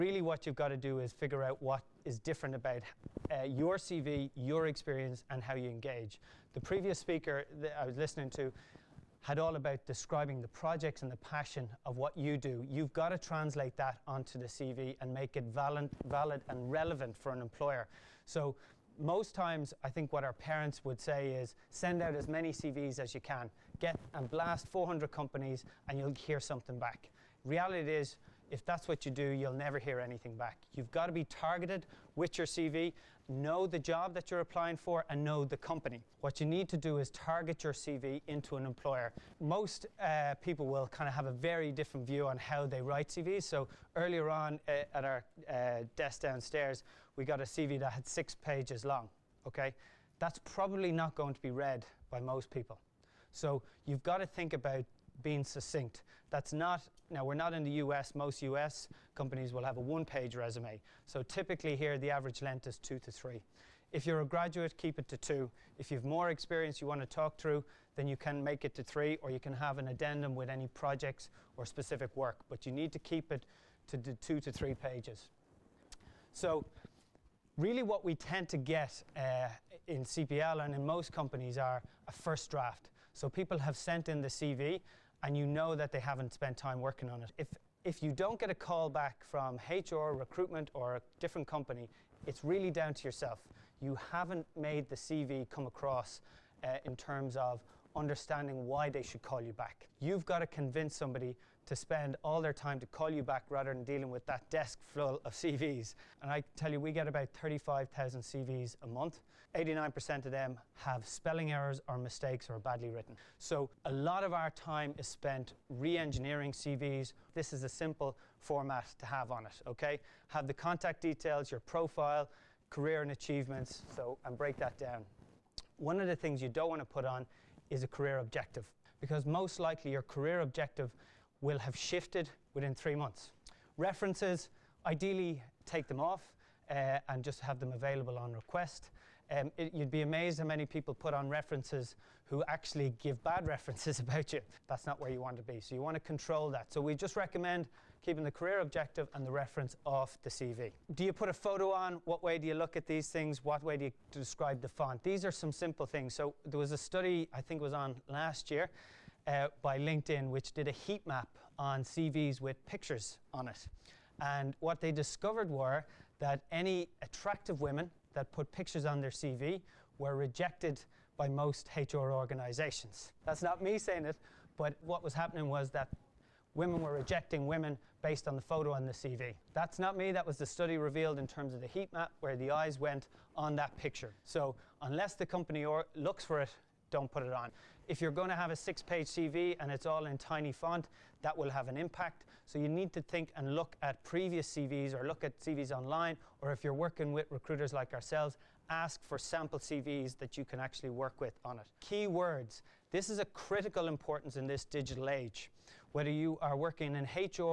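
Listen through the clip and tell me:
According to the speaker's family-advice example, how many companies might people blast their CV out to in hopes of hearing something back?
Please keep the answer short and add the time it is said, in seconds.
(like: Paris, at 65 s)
400, at 24 s.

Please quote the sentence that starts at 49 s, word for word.
Okay, that's probably not going to be read by most people.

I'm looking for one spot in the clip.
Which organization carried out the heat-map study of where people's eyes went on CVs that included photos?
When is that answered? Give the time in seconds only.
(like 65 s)
159 s.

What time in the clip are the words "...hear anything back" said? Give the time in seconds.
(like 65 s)
29 s.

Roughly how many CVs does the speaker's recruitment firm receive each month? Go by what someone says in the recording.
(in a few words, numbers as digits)
35,000.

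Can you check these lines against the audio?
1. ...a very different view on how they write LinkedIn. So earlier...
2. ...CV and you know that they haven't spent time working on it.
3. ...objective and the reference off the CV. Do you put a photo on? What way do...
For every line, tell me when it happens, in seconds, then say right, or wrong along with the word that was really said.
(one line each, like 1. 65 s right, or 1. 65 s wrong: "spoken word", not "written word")
1. 41 s wrong: "CVs", not "LinkedIn"
2. 84 s right
3. 148 s right.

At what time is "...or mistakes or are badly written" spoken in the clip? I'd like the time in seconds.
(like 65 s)
111 s.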